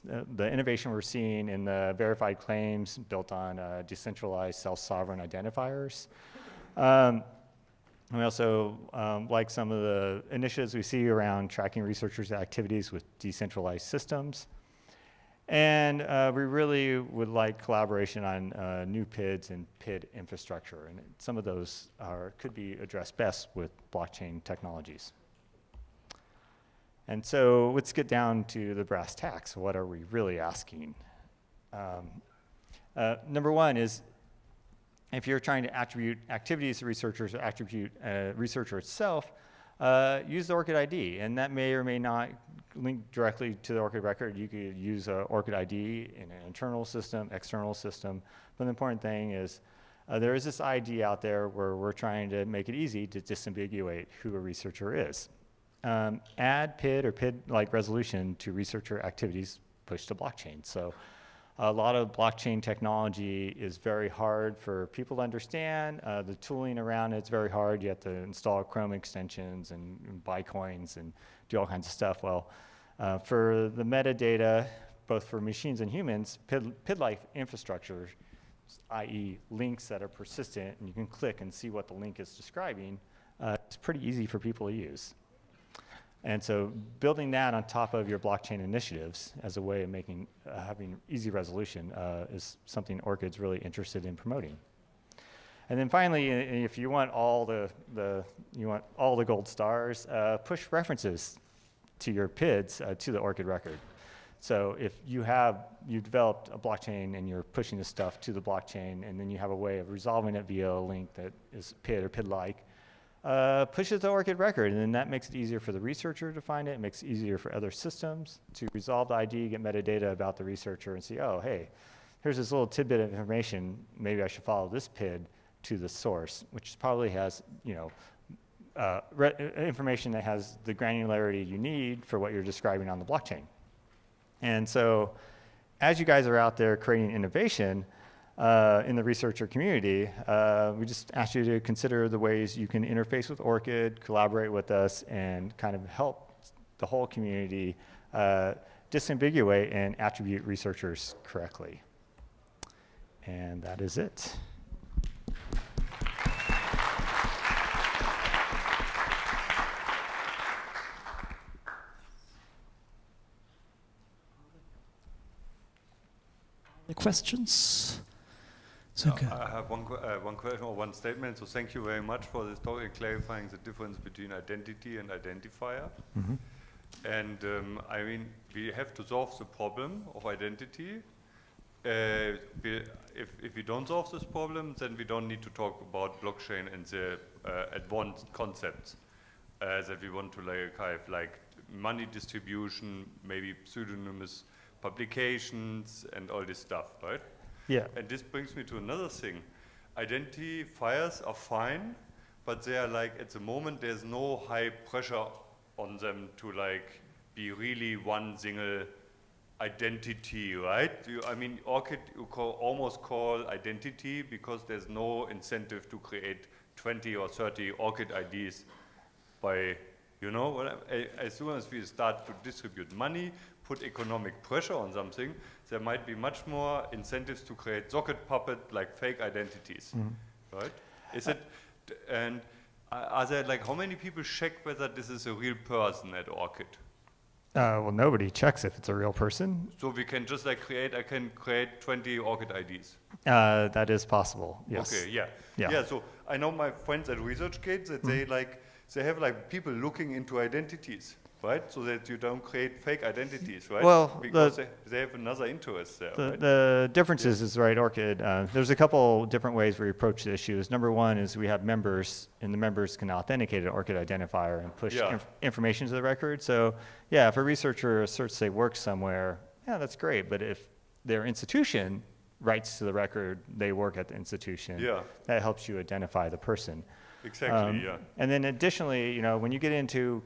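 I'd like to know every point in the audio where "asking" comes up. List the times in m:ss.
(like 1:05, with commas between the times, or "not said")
0:30.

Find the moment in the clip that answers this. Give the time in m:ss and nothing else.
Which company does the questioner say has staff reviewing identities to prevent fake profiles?
4:07.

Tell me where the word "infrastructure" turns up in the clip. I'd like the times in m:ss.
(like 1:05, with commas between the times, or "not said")
0:20, 1:17.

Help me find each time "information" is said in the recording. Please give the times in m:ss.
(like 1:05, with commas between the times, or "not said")
2:03, 2:09, 4:25.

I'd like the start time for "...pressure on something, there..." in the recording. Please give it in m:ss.
3:44.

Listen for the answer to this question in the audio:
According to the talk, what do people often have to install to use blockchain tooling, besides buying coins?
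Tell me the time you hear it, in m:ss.
1:08.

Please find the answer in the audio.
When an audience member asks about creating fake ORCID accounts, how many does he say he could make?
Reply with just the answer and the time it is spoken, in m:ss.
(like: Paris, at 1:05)
20, at 4:01.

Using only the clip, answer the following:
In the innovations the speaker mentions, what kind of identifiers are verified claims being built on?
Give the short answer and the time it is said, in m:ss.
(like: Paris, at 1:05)
decentralized self-sovereign identifiers, at 0:03.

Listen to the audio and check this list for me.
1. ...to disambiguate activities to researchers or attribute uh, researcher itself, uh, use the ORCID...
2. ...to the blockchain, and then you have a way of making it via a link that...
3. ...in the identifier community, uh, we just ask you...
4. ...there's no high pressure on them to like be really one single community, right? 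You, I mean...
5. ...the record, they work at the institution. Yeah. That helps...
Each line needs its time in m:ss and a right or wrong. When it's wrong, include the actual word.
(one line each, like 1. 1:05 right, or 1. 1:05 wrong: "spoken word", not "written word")
1. 0:35 wrong: "attribute", not "disambiguate"
2. 1:48 wrong: "resolving", not "making"
3. 2:18 wrong: "researcher", not "identifier"
4. 3:23 wrong: "identity", not "community"
5. 4:32 right.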